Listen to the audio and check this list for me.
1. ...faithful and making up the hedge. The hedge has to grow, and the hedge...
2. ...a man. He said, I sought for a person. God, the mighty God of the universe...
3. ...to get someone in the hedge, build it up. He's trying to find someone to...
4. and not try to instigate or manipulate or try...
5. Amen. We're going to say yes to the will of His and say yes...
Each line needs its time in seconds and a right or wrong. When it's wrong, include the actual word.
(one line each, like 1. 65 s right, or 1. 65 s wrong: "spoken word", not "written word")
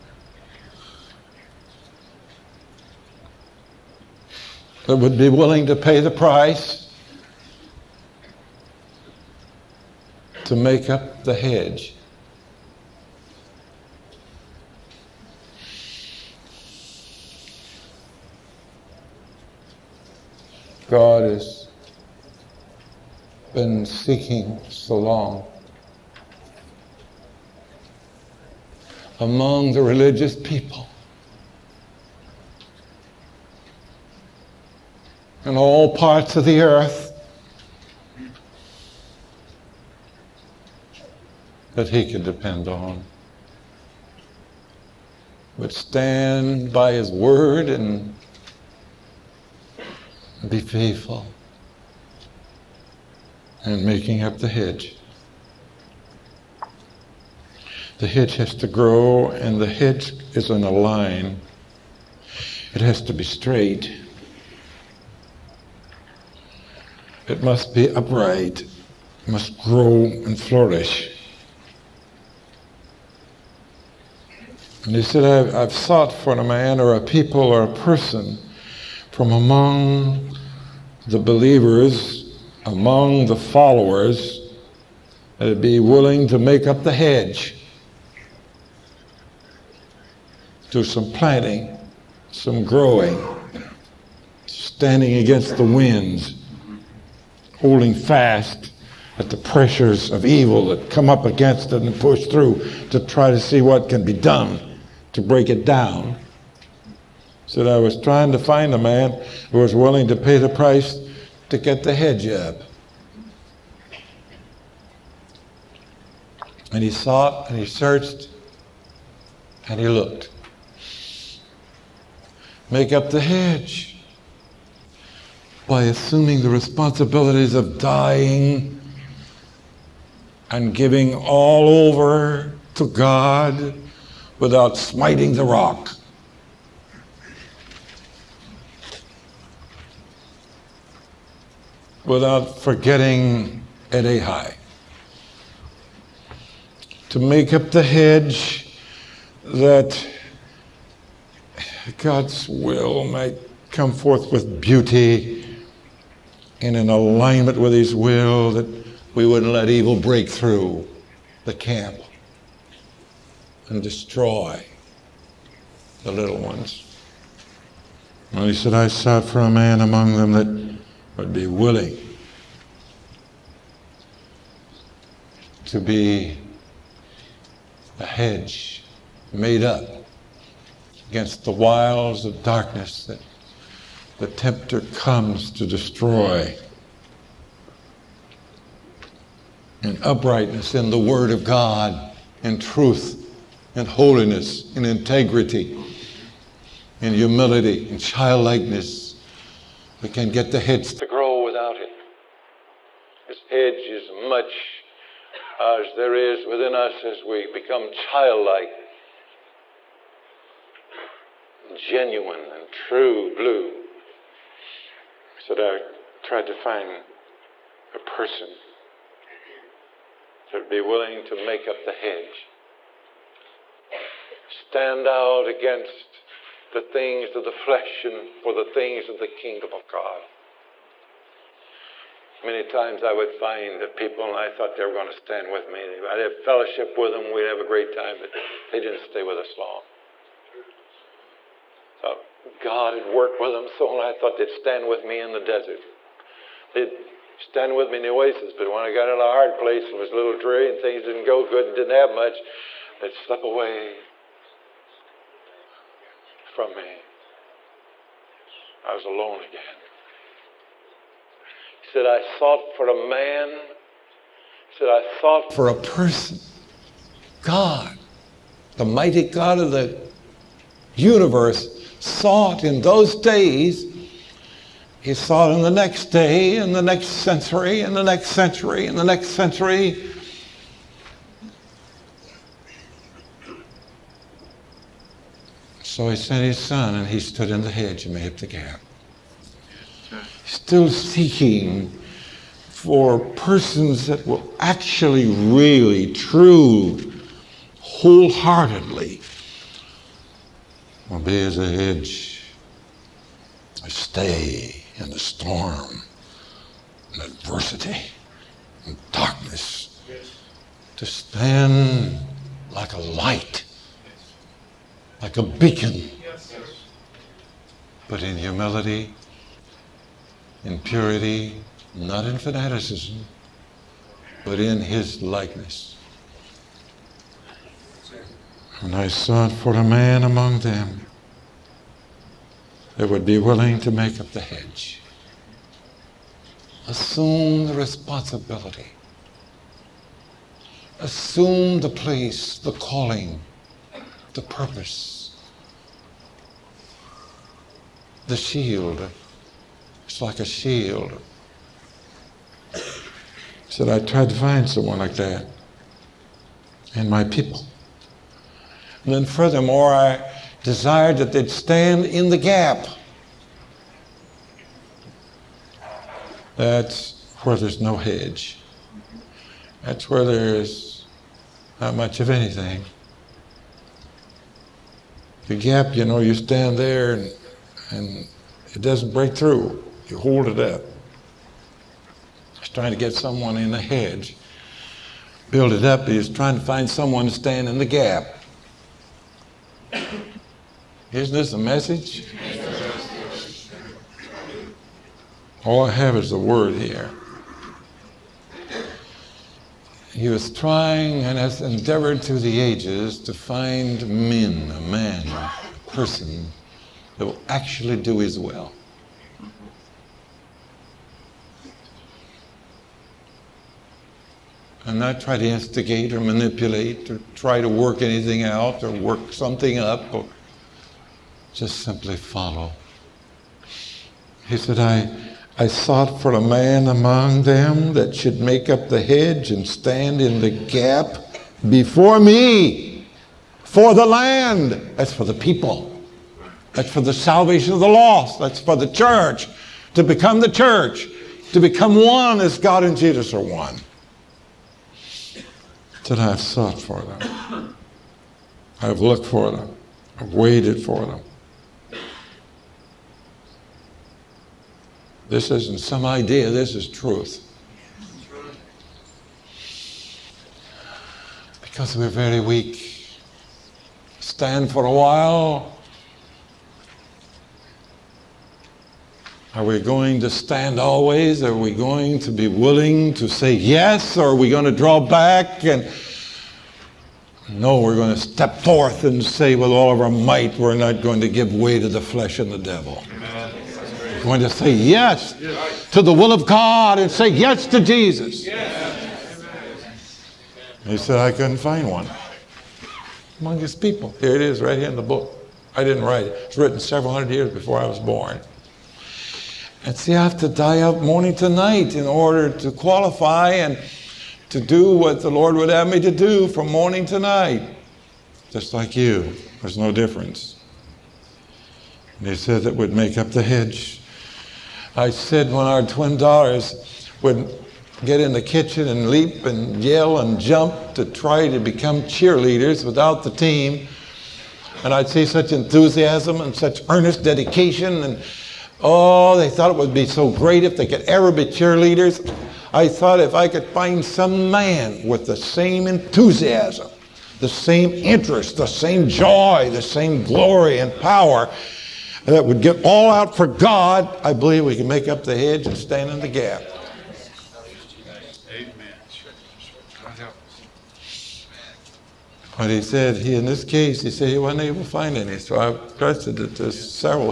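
1. 50 s right
2. 262 s right
3. 382 s right
4. 414 s right
5. 483 s wrong: "God", not "His".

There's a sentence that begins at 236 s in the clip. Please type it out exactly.
I'd have fellowship with them, we'd have a great time, but they didn't stay with us long.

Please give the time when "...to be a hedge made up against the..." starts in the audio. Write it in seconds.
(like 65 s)
175 s.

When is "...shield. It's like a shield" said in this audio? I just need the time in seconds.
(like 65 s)
348 s.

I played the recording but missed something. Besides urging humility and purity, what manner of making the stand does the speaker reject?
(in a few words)
Fanaticism.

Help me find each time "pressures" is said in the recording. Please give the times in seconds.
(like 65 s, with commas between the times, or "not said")
99 s.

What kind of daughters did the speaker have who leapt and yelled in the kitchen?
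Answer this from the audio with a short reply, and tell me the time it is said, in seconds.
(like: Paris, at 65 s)
Twin daughters, at 515 s.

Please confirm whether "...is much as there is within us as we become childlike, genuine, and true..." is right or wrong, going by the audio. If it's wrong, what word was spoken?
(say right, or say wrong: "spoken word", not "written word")
right.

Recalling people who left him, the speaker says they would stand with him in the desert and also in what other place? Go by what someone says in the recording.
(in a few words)
The oasis.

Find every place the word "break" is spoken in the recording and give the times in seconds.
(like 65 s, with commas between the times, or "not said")
105 s, 159 s, 379 s.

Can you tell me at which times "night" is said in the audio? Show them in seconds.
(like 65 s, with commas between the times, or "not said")
501 s, 507 s.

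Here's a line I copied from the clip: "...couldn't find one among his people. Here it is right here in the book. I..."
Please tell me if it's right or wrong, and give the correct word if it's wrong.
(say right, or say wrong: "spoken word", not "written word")
right.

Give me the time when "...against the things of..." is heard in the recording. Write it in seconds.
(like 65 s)
225 s.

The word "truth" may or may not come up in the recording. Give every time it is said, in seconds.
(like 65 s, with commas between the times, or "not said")
192 s, 456 s.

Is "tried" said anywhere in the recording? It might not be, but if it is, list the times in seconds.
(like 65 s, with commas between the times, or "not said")
216 s, 354 s.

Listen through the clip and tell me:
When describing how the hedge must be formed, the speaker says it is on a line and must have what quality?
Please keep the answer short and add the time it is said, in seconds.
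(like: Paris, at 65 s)
Straight, at 63 s.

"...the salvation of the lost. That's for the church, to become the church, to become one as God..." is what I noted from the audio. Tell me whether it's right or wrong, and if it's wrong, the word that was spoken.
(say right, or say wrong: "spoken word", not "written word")
right.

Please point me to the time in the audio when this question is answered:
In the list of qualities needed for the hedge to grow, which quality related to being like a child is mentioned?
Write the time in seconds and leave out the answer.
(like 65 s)
197 s.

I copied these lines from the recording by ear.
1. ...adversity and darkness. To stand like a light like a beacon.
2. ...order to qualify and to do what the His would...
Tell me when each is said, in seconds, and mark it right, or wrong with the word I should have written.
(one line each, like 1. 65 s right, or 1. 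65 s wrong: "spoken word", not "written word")
1. 307 s right
2. 502 s wrong: "Lord", not "His".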